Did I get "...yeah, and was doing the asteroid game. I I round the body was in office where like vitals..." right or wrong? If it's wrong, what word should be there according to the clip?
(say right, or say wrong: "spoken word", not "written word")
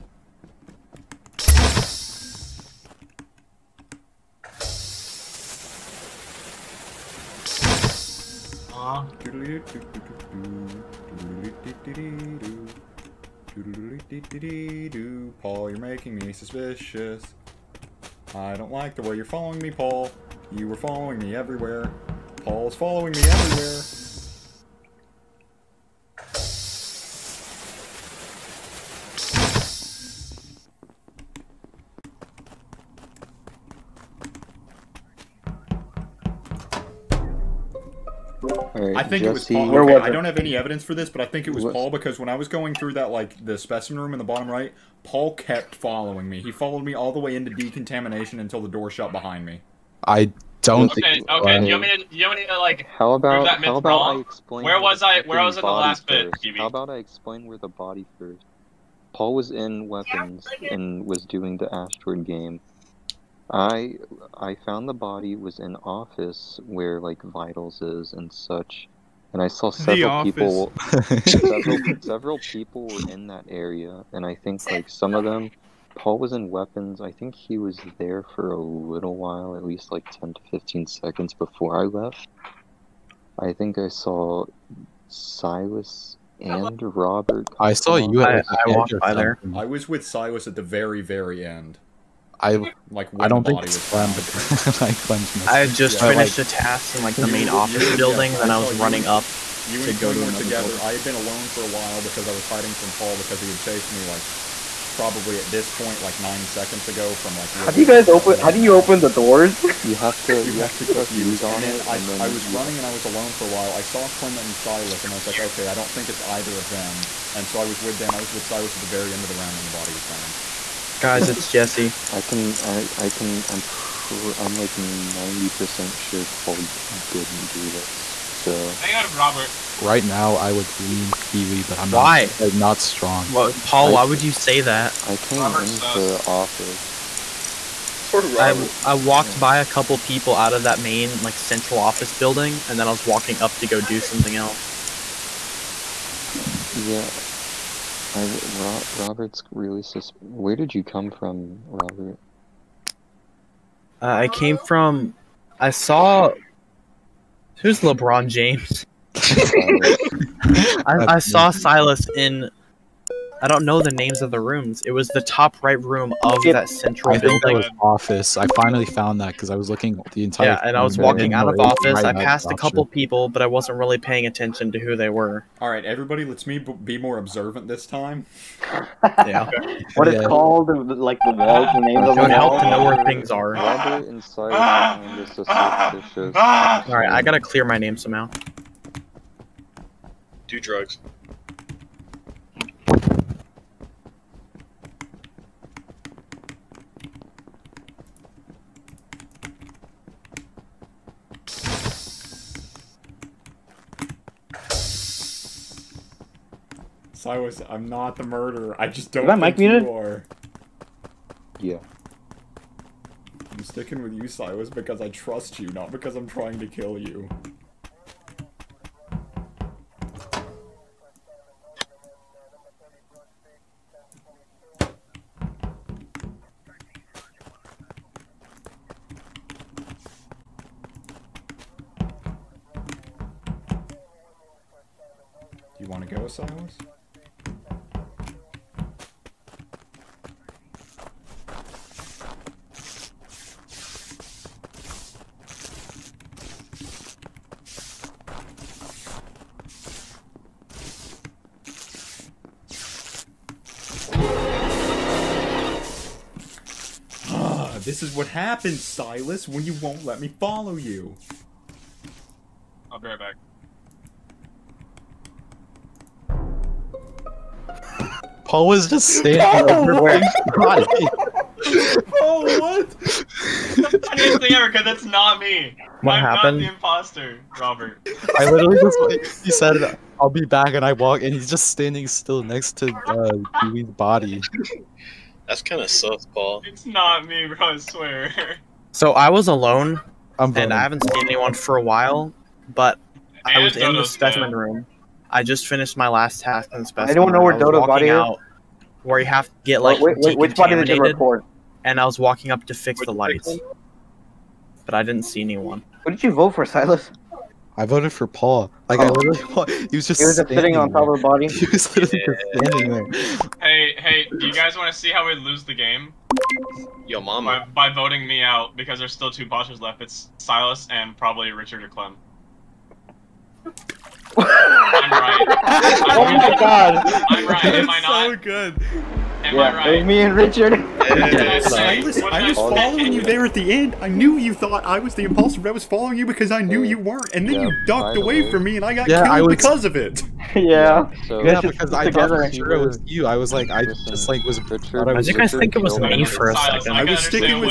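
wrong: "found", not "round".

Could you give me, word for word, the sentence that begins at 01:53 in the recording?
I saw Clem and Silas, and I was like, okay, I don't think it's either of them.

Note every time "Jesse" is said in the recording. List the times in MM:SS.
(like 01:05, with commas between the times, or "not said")
00:39, 02:01.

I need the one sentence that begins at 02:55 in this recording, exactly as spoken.
All right, everybody, let's me be more observant this time.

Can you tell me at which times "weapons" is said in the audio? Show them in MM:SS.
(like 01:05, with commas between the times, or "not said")
00:59, 01:16.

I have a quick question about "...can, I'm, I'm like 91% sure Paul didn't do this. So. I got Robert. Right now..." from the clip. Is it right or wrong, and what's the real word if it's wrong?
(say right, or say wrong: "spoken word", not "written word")
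wrong: "90", not "91".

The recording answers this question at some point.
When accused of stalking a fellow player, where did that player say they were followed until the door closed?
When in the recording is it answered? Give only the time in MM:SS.
00:47.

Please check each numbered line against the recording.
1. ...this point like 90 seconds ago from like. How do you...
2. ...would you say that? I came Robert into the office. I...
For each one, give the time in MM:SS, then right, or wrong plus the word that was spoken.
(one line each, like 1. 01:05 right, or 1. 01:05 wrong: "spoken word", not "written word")
1. 01:45 right
2. 02:14 right.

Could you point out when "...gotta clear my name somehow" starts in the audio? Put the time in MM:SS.
03:07.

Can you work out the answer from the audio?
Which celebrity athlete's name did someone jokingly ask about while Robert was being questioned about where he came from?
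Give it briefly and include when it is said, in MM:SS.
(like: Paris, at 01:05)
LeBron James, at 02:37.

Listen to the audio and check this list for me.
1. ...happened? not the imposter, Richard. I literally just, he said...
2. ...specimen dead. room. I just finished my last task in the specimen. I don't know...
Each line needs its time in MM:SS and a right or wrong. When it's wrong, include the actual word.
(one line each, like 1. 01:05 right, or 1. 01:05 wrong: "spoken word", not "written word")
1. 04:36 wrong: "Robert", not "Richard"
2. 04:54 right.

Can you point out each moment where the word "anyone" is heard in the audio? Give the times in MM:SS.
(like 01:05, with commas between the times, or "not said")
04:51, 05:05.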